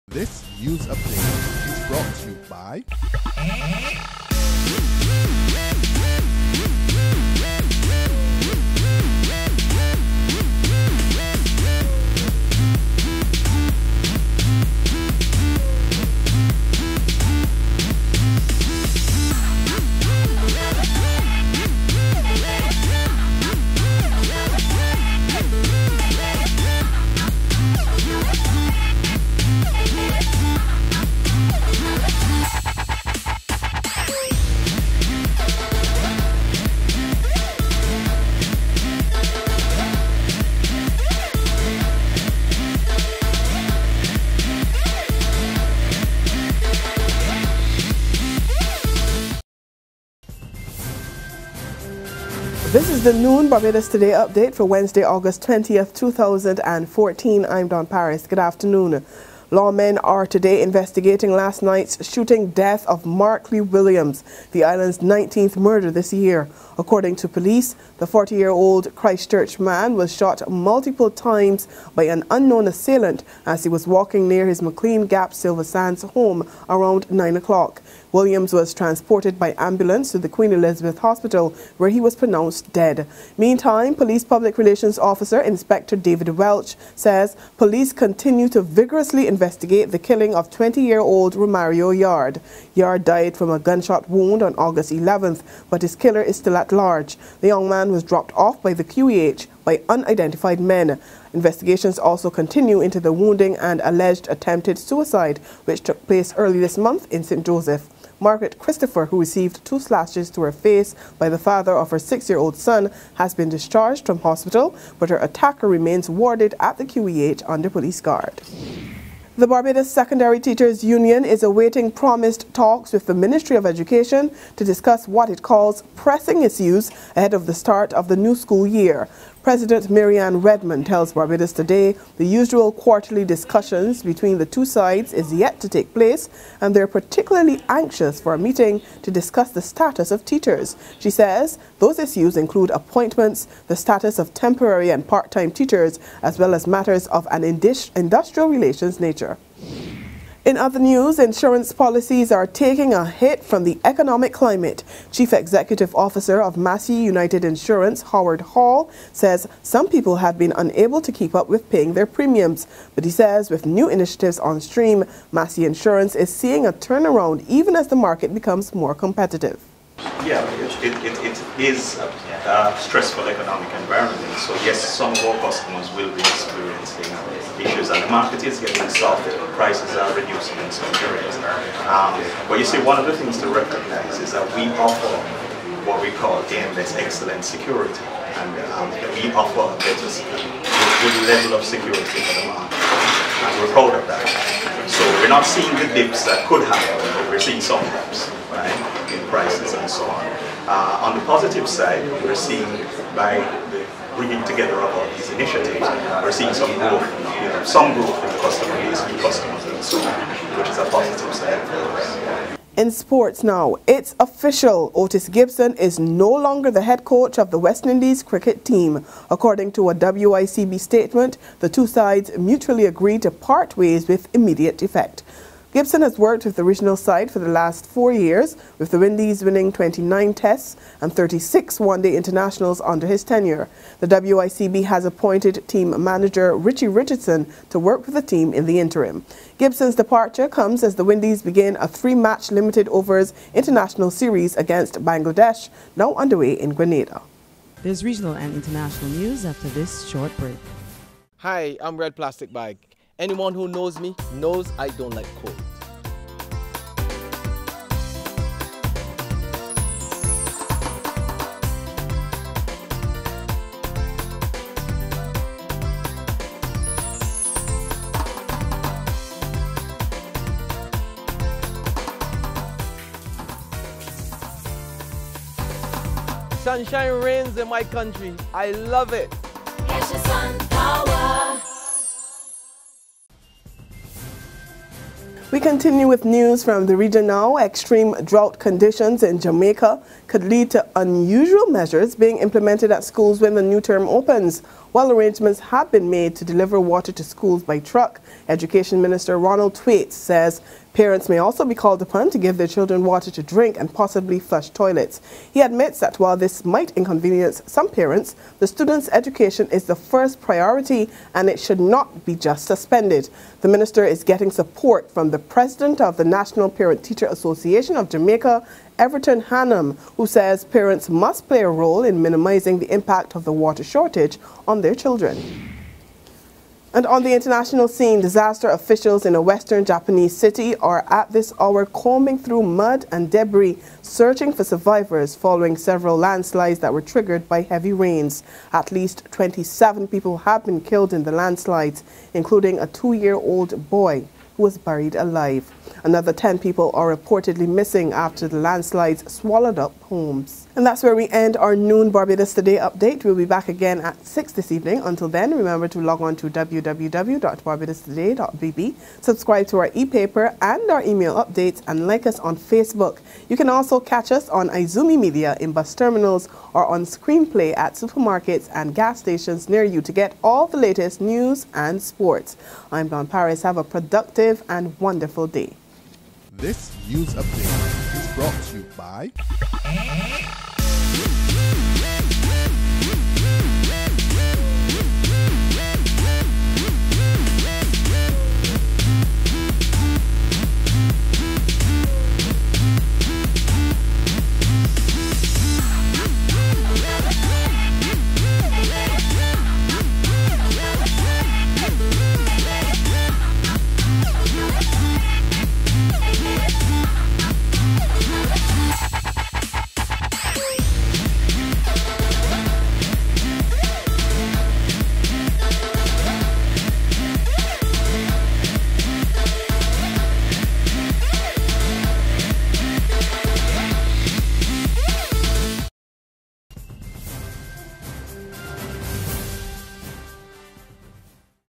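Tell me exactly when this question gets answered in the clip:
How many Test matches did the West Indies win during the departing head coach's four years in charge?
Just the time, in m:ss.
3:49.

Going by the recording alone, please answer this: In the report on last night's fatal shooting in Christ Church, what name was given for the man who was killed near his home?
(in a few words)
Markley Williams.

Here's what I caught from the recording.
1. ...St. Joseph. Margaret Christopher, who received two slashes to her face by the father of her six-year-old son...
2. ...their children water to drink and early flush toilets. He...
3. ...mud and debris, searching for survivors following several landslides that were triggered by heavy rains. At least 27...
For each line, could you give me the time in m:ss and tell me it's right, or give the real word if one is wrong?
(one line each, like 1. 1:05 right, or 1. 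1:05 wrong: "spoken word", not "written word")
1. 1:47 right
2. 5:02 wrong: "possibly", not "early"
3. 5:32 right.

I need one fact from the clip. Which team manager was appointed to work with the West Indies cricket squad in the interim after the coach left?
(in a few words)
Richie Richardson.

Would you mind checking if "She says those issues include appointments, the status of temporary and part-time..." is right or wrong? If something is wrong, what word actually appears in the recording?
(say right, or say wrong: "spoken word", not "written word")
right.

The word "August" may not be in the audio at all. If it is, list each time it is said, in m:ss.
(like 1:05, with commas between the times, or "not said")
0:55, 1:34.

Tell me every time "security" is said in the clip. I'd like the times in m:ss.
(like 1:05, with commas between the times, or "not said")
3:07, 3:11.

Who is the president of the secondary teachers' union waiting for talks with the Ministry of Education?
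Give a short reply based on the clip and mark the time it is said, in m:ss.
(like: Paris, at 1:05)
Marianne Redman, at 2:09.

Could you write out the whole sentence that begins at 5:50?
And that's where we end our noon Barbados Today update.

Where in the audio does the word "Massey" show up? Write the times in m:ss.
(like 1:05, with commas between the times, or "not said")
2:36, 2:45.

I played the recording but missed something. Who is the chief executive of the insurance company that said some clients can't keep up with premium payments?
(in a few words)
Howard Hall.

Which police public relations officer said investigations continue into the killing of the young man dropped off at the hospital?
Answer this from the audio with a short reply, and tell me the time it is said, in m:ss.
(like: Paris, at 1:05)
David Welch, at 1:25.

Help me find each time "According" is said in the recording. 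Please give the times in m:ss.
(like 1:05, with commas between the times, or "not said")
1:06, 3:39.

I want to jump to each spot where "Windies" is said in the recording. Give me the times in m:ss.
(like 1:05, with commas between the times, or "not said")
3:48, 4:01.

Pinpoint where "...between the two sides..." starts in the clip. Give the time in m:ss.
2:14.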